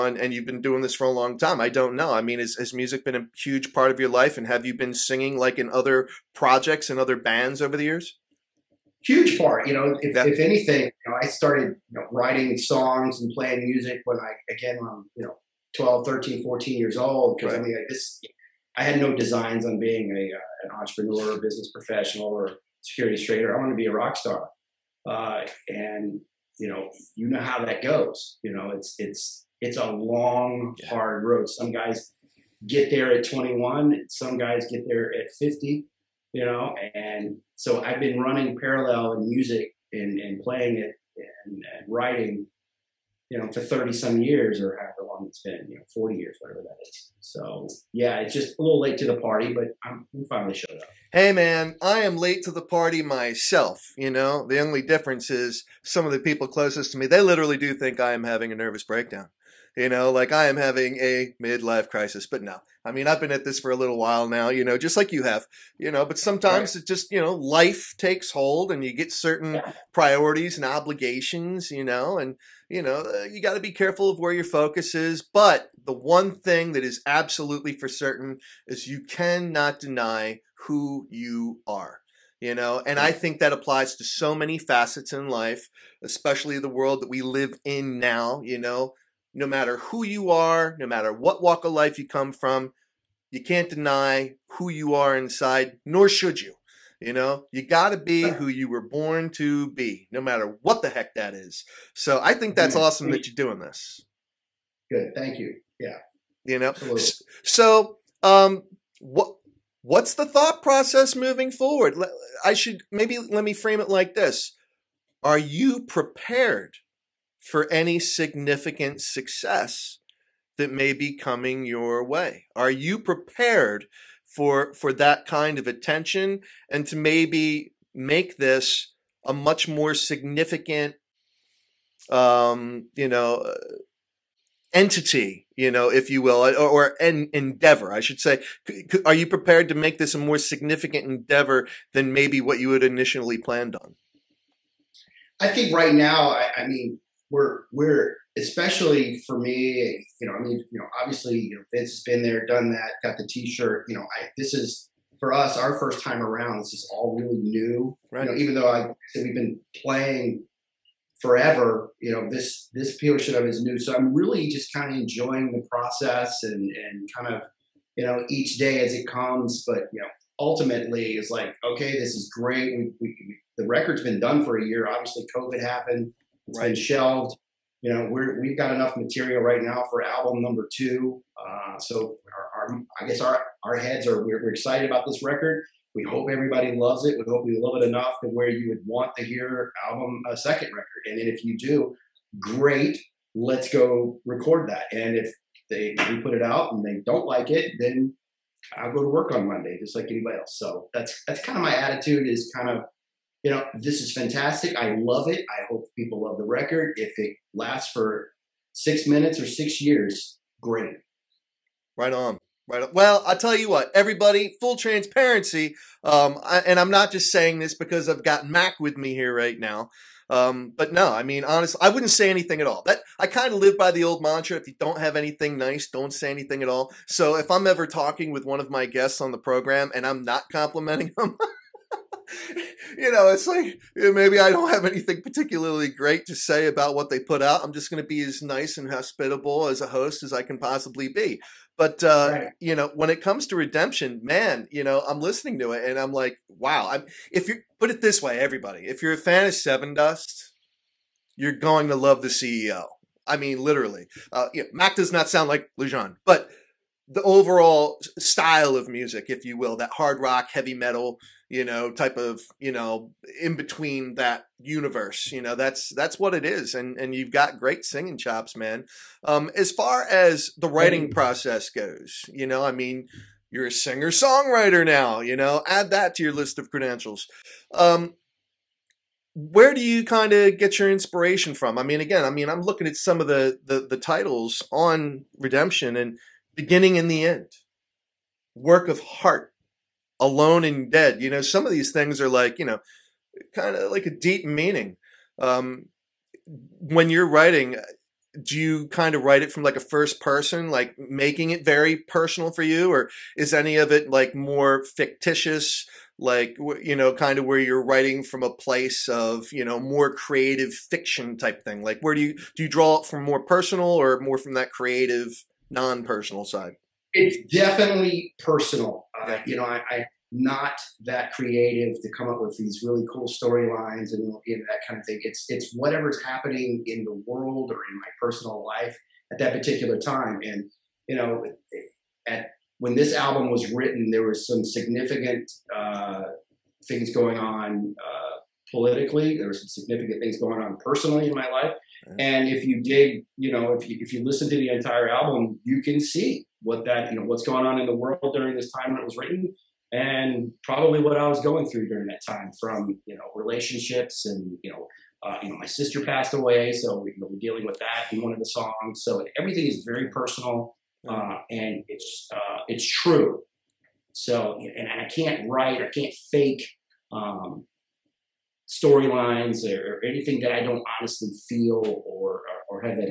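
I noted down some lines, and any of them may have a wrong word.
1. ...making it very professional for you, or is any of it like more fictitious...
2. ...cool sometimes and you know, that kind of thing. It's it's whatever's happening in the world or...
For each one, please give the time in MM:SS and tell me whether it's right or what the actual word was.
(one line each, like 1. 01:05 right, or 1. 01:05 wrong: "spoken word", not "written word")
1. 05:00 wrong: "personal", not "professional"
2. 05:23 wrong: "storylines", not "sometimes".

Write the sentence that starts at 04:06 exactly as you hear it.
I'm, if you put it this way, everybody, if you're a fan of Sevendust, you're going to love the CEO.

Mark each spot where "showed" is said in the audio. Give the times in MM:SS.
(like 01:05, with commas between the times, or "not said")
00:50.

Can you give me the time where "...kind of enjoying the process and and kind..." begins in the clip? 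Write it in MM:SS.
02:44.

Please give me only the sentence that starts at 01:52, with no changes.
I should maybe let me frame it like this.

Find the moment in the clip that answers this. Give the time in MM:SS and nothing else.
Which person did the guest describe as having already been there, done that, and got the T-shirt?
02:31.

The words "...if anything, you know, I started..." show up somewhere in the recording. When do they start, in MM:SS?
00:10.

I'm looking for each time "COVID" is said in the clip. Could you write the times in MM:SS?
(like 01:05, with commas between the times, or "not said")
02:55.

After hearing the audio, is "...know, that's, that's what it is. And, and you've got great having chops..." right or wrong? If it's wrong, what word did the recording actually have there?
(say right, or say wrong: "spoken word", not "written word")
wrong: "singing", not "having".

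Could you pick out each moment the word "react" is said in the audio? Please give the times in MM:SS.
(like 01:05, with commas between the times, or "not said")
not said.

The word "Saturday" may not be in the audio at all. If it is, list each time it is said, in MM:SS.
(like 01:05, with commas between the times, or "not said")
not said.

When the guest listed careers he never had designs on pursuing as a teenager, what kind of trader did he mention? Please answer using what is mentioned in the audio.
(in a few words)
securities trader.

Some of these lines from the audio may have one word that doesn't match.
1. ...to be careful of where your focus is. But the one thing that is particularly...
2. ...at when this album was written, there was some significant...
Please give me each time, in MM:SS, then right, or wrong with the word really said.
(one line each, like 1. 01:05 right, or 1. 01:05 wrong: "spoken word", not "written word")
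1. 01:13 wrong: "absolutely", not "particularly"
2. 05:32 right.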